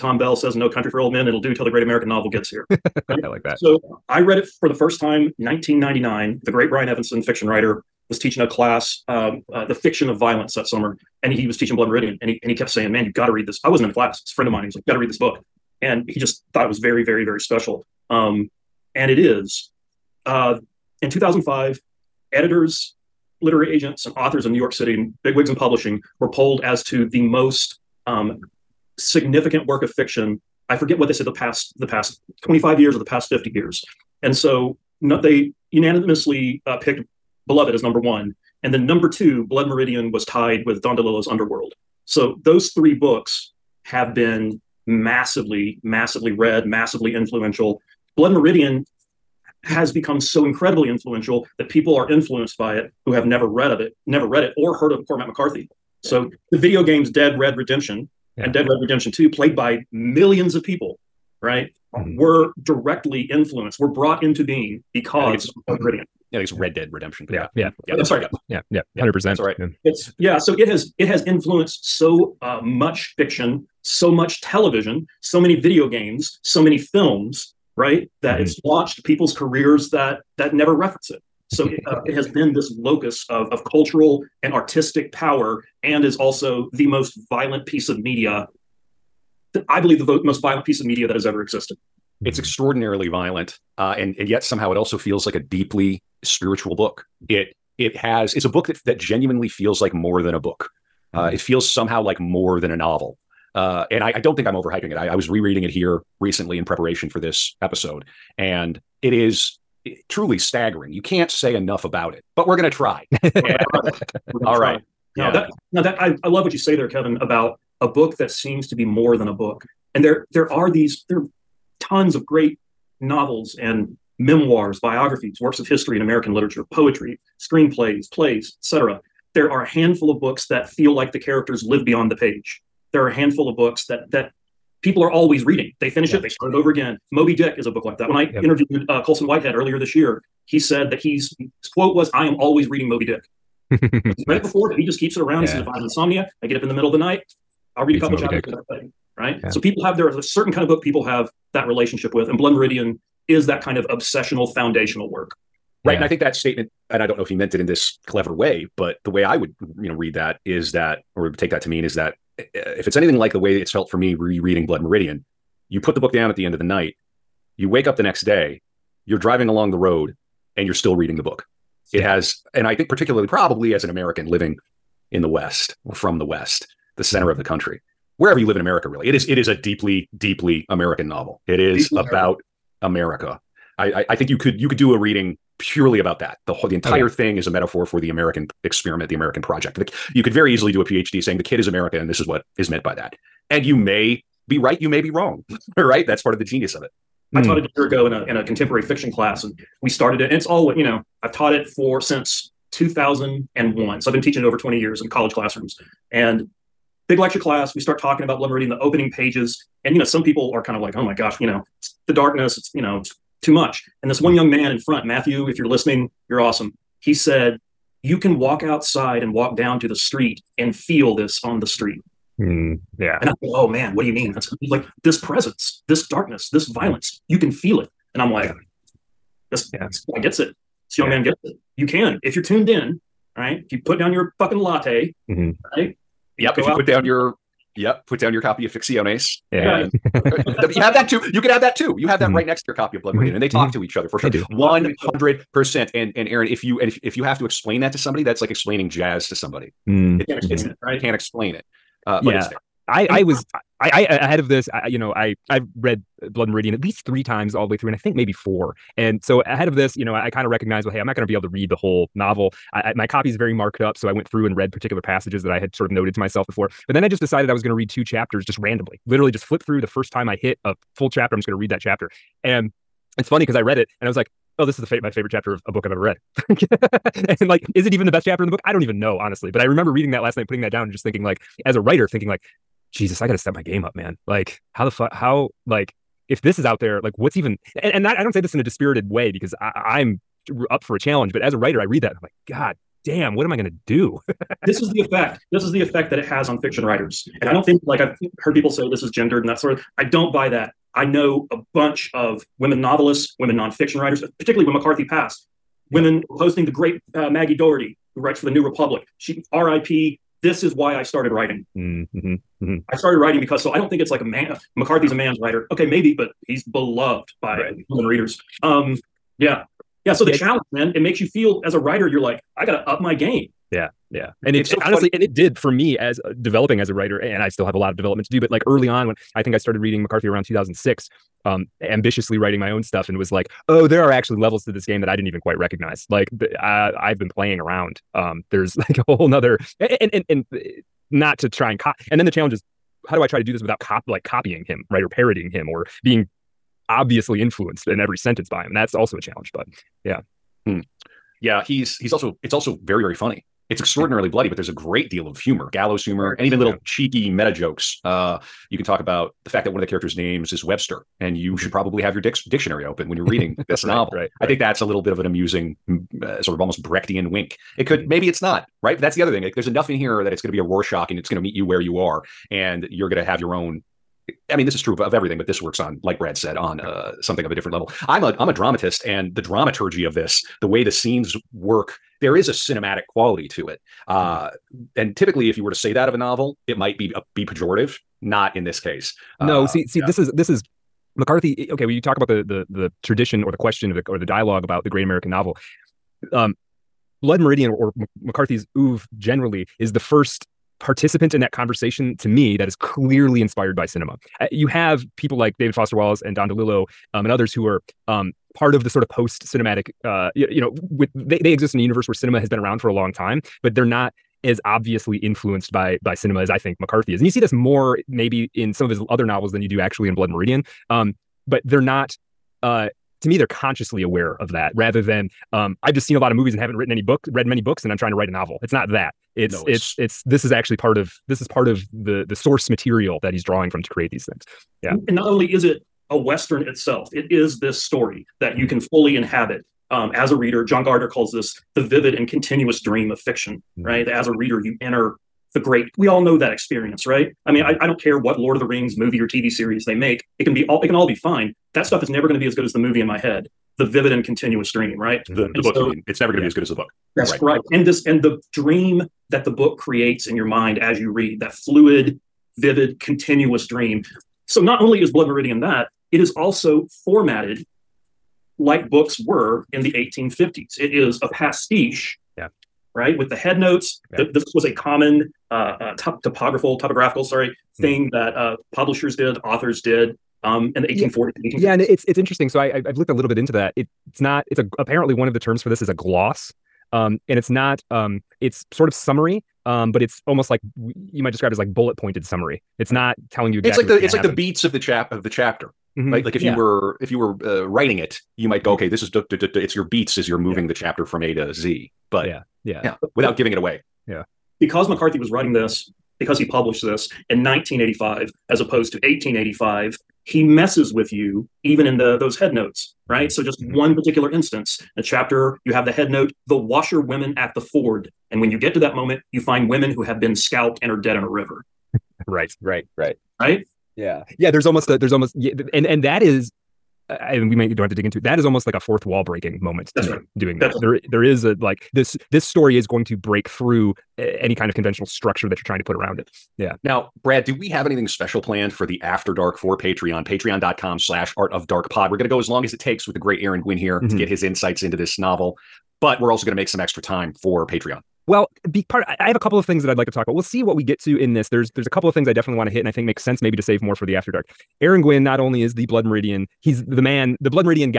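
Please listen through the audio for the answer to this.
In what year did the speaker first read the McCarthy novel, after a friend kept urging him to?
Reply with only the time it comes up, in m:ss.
0:05.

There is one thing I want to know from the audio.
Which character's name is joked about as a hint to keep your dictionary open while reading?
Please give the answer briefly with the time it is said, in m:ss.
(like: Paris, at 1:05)
Webster, at 6:00.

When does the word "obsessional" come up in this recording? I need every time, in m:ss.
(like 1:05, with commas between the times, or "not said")
2:33.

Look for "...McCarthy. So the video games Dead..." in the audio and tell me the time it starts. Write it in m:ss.
0:55.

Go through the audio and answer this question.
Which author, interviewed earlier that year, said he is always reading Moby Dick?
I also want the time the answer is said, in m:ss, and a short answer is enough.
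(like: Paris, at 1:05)
Colson Whitehead, at 2:19.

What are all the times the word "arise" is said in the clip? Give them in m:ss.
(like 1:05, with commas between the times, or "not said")
not said.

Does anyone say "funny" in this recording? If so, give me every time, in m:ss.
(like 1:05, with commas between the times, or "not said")
4:33, 5:53.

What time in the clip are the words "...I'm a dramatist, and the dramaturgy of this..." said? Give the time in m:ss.
6:18.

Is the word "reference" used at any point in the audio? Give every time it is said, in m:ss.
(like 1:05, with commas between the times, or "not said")
1:20.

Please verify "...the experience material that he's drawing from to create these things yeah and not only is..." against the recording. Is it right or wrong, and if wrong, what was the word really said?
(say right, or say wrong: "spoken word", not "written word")
wrong: "source", not "experience".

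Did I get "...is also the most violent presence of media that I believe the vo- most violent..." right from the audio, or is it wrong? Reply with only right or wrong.
wrong.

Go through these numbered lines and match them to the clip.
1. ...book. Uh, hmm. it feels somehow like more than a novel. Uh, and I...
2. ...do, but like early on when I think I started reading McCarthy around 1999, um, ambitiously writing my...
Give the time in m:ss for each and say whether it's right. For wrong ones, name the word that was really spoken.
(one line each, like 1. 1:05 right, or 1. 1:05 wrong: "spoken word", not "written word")
1. 1:40 right
2. 5:28 wrong: "2006", not "1999".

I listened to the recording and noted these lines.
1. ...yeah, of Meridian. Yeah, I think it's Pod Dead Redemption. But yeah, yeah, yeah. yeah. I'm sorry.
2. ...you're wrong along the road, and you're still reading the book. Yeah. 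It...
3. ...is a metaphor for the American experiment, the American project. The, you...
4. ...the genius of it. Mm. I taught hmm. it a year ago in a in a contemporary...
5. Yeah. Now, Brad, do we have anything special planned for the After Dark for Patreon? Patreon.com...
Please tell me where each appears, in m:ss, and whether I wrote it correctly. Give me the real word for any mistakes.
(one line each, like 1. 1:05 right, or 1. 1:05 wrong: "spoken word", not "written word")
1. 1:05 wrong: "Red", not "Pod"
2. 2:49 wrong: "driving", not "wrong"
3. 3:07 right
4. 3:16 right
5. 8:56 right.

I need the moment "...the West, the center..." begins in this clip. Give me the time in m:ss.
2:56.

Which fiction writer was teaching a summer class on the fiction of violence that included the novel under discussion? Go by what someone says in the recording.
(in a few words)
Brian Evenson.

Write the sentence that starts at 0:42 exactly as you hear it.
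So those three books have been massively, massively read, massively influential.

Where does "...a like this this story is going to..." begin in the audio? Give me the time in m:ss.
8:51.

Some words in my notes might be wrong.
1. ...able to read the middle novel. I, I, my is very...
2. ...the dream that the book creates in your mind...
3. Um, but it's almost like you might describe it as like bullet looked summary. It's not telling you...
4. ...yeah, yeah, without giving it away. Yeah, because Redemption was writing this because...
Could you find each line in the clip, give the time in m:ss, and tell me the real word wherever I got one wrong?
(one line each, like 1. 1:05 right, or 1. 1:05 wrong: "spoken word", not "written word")
1. 4:21 wrong: "whole", not "middle"
2. 7:38 right
3. 8:09 wrong: "pointed", not "looked"
4. 8:22 wrong: "McCarthy", not "Redemption".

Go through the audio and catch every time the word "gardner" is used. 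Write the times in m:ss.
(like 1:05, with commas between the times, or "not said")
7:20.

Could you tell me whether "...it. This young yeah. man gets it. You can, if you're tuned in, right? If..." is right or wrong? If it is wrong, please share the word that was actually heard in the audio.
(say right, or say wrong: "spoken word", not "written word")
right.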